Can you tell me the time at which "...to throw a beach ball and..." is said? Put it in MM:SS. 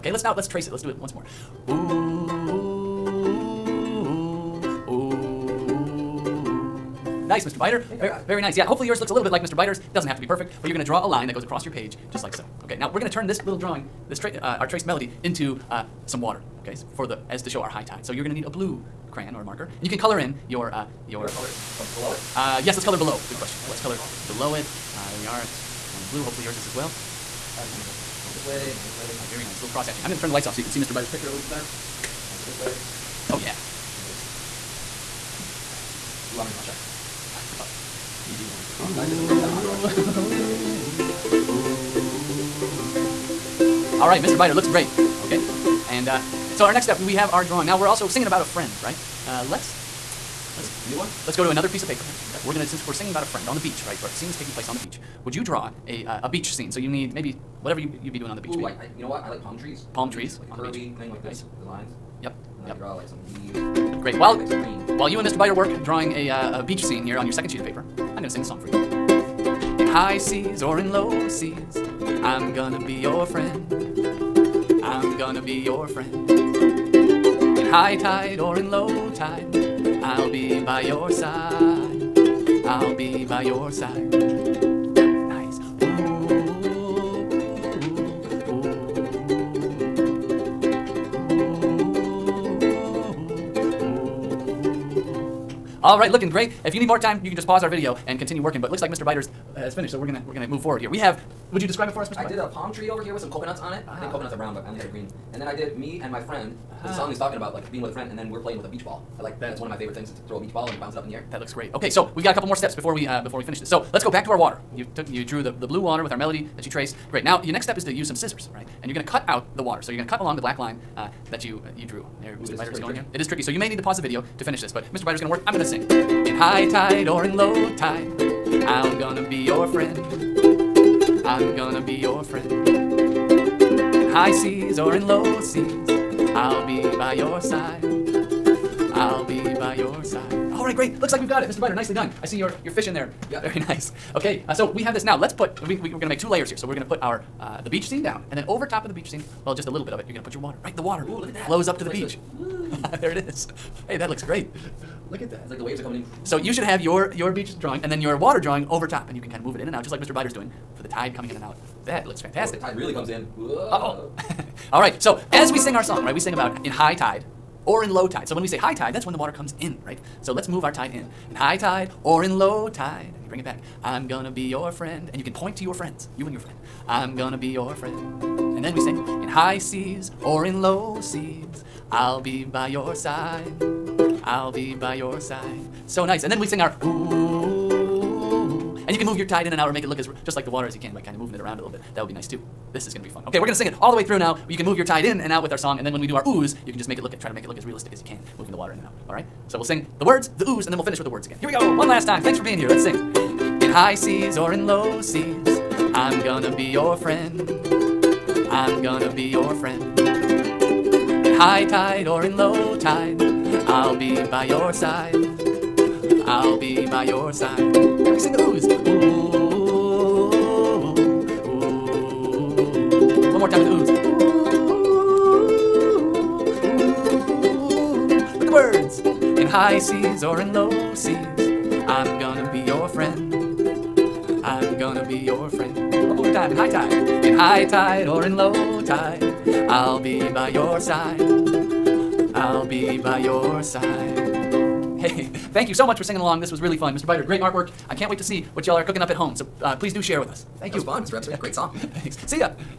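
01:50.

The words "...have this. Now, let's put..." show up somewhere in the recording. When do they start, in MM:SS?
02:24.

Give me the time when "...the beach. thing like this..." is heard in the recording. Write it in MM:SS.
01:00.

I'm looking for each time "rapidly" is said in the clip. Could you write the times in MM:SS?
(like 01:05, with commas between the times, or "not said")
not said.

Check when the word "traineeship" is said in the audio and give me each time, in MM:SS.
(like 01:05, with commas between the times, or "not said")
not said.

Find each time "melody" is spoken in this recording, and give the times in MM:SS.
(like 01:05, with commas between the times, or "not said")
00:14, 01:56.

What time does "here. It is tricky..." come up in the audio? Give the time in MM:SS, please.
02:02.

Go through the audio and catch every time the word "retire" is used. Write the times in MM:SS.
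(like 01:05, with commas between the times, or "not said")
not said.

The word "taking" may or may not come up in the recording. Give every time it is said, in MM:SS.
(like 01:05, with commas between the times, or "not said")
00:54.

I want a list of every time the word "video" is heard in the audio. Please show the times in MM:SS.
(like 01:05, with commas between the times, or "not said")
01:37, 02:04.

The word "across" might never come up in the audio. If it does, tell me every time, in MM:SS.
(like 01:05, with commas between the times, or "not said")
00:11.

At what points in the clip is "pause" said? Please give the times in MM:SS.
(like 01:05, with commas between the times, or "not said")
01:37, 02:03.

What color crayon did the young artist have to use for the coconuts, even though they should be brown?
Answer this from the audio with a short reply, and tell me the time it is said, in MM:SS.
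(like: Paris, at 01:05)
Green, at 01:44.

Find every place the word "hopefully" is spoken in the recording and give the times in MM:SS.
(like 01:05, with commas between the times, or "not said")
00:08, 00:26.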